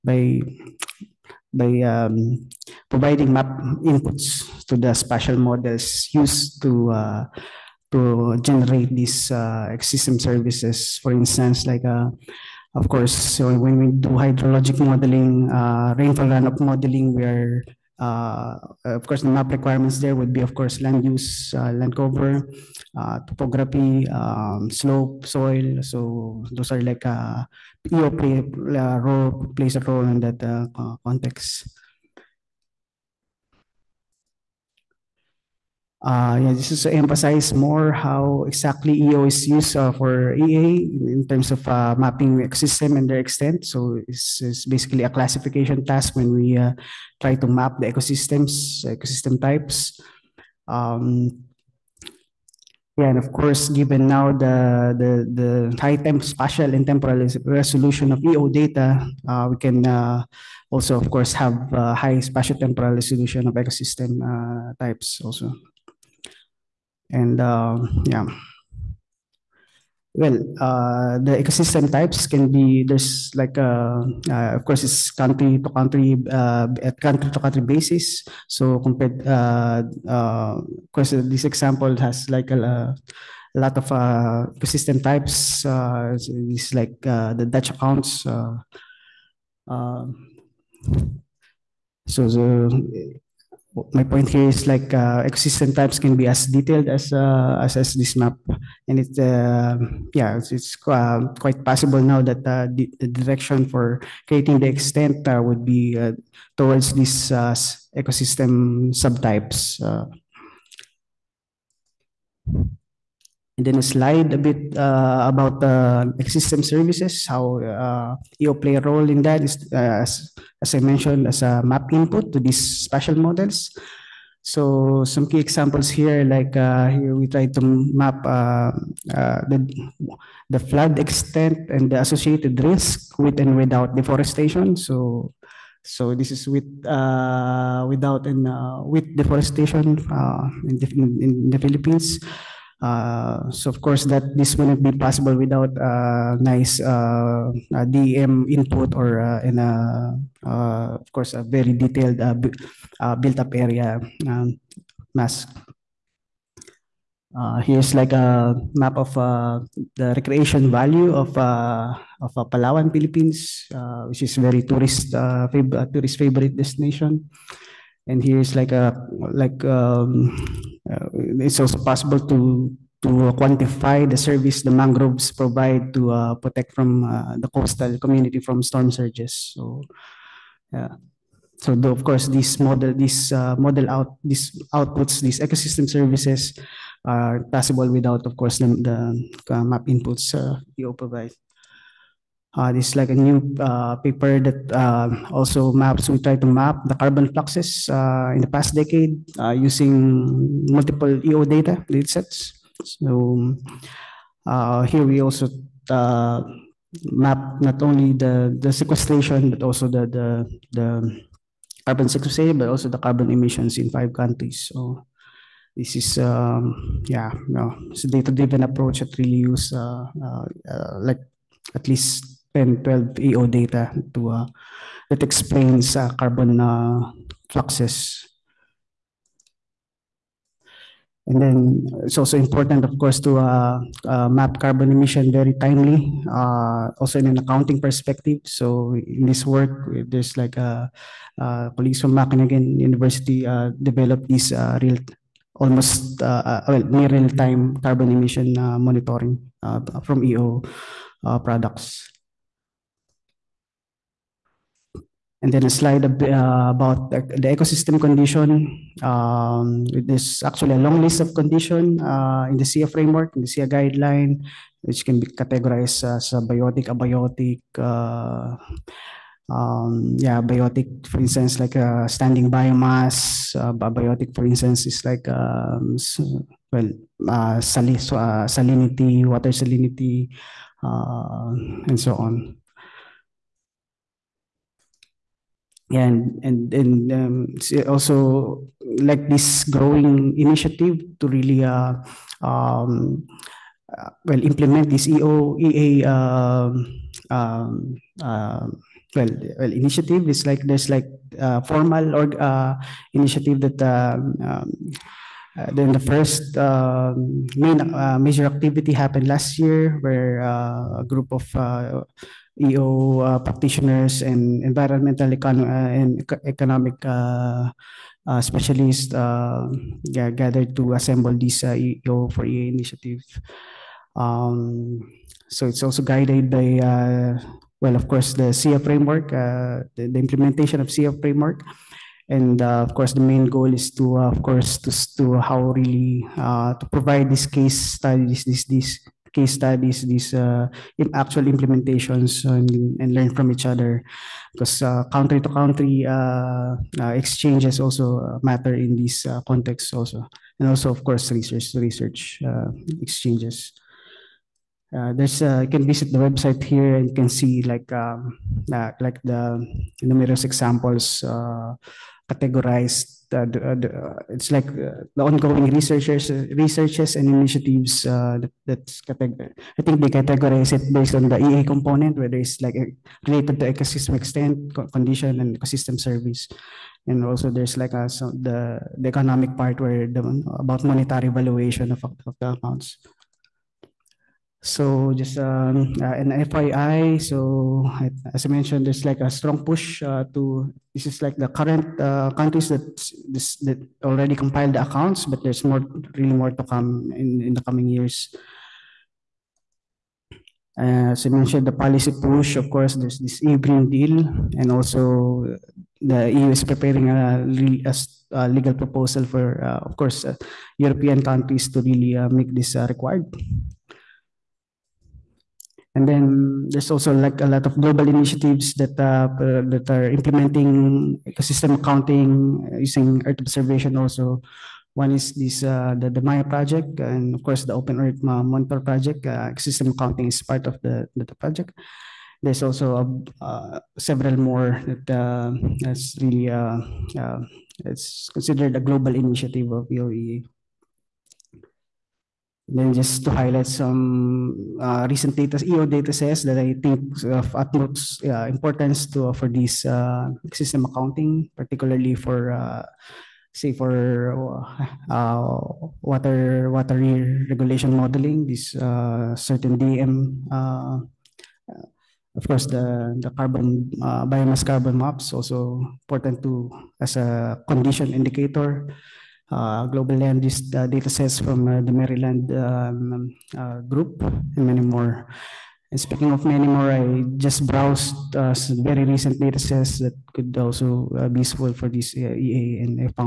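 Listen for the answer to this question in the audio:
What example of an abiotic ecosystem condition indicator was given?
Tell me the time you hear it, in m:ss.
4:39.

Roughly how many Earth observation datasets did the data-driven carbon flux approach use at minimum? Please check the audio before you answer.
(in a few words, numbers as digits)
12.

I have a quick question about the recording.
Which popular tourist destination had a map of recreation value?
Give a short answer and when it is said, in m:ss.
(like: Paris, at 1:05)
Palawan, at 2:42.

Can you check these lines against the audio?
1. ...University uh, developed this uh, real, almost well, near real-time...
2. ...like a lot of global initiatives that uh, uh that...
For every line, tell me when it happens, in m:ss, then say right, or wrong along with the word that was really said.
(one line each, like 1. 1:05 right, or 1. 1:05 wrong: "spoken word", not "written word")
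1. 4:02 right
2. 6:57 right.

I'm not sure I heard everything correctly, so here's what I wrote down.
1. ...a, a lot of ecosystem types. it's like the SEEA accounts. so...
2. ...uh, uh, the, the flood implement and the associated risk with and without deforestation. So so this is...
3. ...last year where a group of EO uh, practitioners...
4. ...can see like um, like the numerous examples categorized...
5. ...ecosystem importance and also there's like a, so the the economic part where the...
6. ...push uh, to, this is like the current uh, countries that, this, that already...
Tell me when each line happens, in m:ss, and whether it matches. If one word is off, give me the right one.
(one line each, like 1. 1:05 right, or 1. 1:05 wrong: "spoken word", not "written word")
1. 1:22 wrong: "Dutch", not "SEEA"
2. 2:08 wrong: "extent", not "implement"
3. 5:09 right
4. 5:57 right
5. 6:15 wrong: "service", not "importance"
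6. 6:29 right.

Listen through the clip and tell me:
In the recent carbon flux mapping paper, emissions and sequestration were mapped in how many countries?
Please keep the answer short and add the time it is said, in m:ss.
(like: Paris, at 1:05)
5, at 3:33.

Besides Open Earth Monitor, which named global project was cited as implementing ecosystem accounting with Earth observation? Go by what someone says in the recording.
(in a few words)
MAIA.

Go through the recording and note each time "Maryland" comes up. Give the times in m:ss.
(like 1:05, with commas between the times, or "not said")
7:51.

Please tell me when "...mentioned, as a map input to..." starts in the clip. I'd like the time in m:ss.
2:00.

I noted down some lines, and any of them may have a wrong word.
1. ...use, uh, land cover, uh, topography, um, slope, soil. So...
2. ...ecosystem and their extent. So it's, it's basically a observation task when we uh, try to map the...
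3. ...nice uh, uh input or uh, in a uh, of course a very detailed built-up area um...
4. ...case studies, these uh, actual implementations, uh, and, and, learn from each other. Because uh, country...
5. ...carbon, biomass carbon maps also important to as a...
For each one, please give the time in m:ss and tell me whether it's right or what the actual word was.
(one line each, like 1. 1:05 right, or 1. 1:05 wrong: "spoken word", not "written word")
1. 0:21 right
2. 0:42 wrong: "classification", not "observation"
3. 2:26 right
4. 5:39 right
5. 7:43 right.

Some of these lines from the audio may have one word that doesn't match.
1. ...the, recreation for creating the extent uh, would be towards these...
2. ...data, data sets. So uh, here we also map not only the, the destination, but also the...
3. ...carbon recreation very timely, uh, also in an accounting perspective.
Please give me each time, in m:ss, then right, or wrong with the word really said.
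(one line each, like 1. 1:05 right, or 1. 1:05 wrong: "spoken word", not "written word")
1. 1:42 wrong: "direction", not "recreation"
2. 3:21 wrong: "sequestration", not "destination"
3. 3:54 wrong: "emission", not "recreation".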